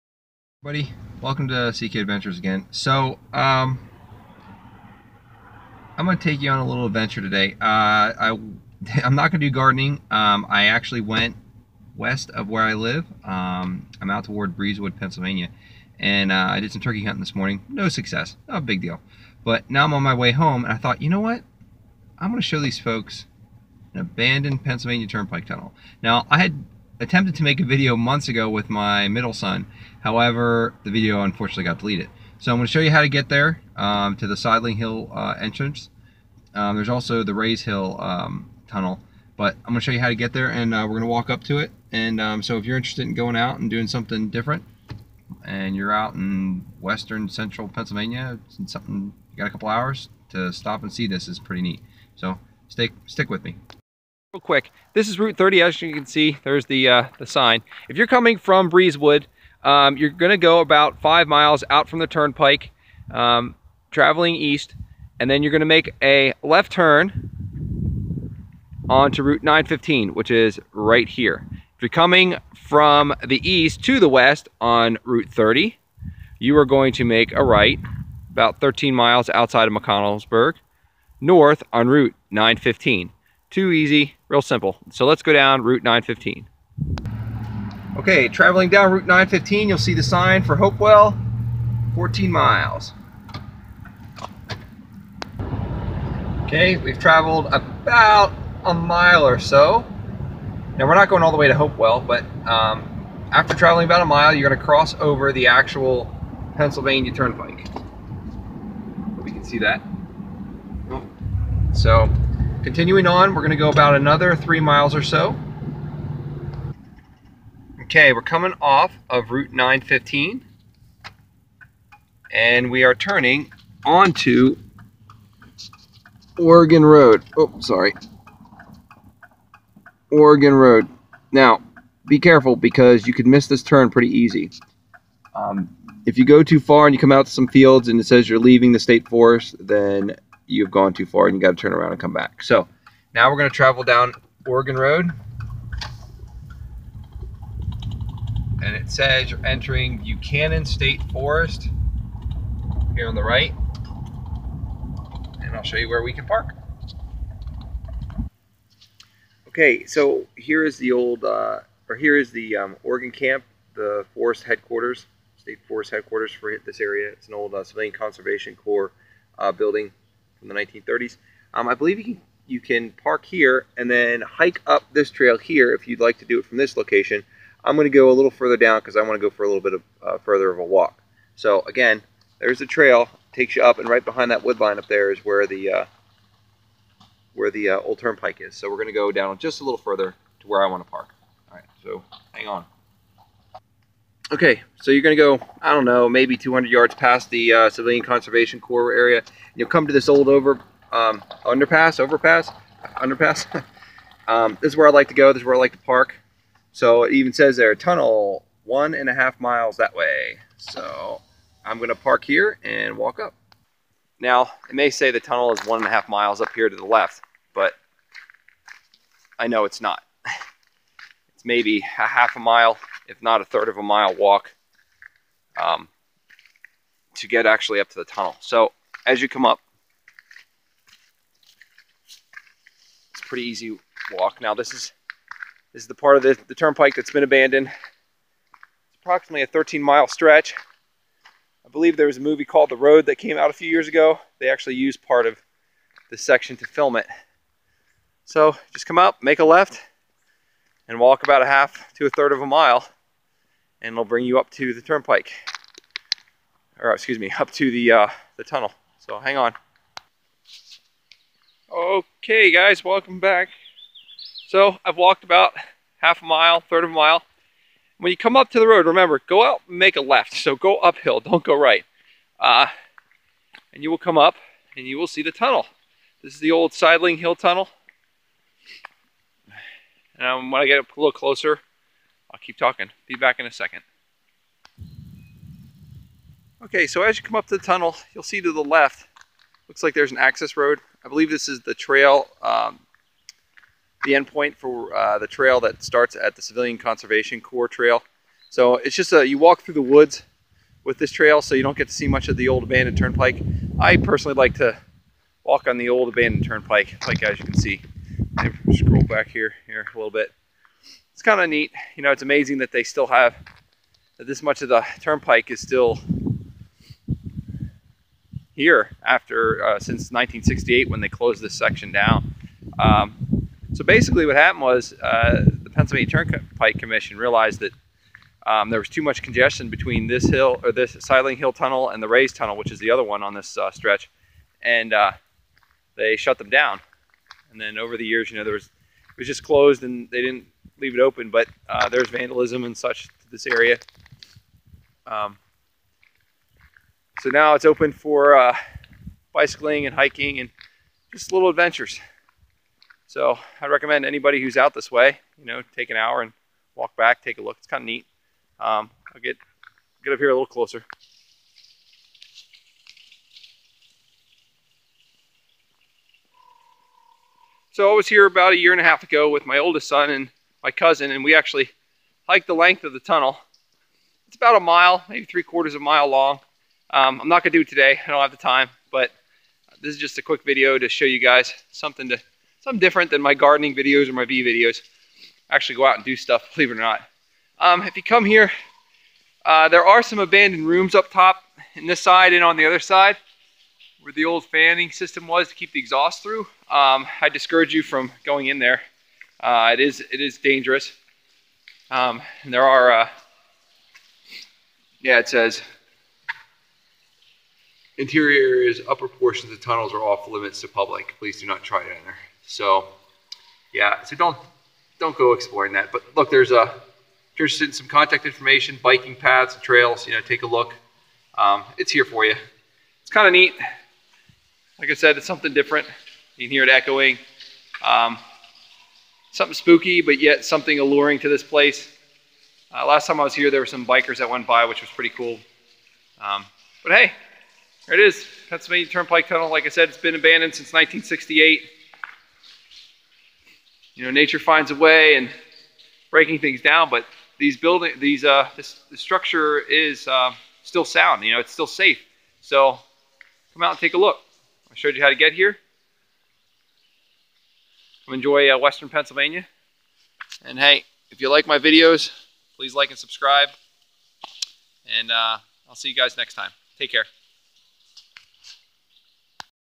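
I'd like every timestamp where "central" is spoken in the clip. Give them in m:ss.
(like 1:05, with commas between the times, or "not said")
0:47.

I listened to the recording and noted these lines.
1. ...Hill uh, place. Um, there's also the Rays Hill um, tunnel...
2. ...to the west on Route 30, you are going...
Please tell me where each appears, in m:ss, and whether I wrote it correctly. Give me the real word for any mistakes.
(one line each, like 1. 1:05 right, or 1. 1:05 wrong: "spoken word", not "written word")
1. 0:34 wrong: "entrance", not "place"
2. 1:13 right.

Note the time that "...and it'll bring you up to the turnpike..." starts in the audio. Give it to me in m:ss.
4:13.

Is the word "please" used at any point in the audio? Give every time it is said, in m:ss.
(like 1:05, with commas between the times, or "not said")
6:51, 7:42.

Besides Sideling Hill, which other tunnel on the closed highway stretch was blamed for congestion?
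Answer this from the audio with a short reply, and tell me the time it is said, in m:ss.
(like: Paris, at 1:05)
Rays Tunnel, at 5:32.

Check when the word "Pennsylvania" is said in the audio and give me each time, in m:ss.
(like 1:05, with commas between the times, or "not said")
0:14, 0:24, 0:47, 1:46, 5:25, 7:18, 7:38.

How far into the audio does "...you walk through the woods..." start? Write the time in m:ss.
4:59.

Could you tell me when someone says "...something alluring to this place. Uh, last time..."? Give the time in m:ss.
7:10.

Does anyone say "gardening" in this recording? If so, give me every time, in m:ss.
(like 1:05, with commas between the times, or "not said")
0:09, 6:23.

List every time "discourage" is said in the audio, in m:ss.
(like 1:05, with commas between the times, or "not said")
6:37.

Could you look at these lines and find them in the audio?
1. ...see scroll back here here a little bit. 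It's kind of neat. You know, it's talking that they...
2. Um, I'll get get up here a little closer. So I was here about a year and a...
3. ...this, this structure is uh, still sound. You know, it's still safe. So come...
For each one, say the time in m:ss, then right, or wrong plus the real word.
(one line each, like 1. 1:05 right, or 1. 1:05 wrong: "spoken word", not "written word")
1. 5:07 wrong: "amazing", not "talking"
2. 5:58 right
3. 7:28 right.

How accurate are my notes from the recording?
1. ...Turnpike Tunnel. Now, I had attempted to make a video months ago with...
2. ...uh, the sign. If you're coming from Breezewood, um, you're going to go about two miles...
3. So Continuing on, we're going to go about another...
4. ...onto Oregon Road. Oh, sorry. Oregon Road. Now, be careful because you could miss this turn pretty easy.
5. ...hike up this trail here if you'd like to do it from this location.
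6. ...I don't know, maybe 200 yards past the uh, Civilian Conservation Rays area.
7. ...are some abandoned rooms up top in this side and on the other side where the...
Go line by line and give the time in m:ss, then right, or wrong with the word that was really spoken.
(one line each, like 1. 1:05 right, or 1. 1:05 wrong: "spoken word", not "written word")
1. 0:25 right
2. 0:56 wrong: "five", not "two"
3. 1:51 right
4. 2:03 right
5. 2:54 right
6. 3:15 wrong: "Corps", not "Rays"
7. 6:29 right.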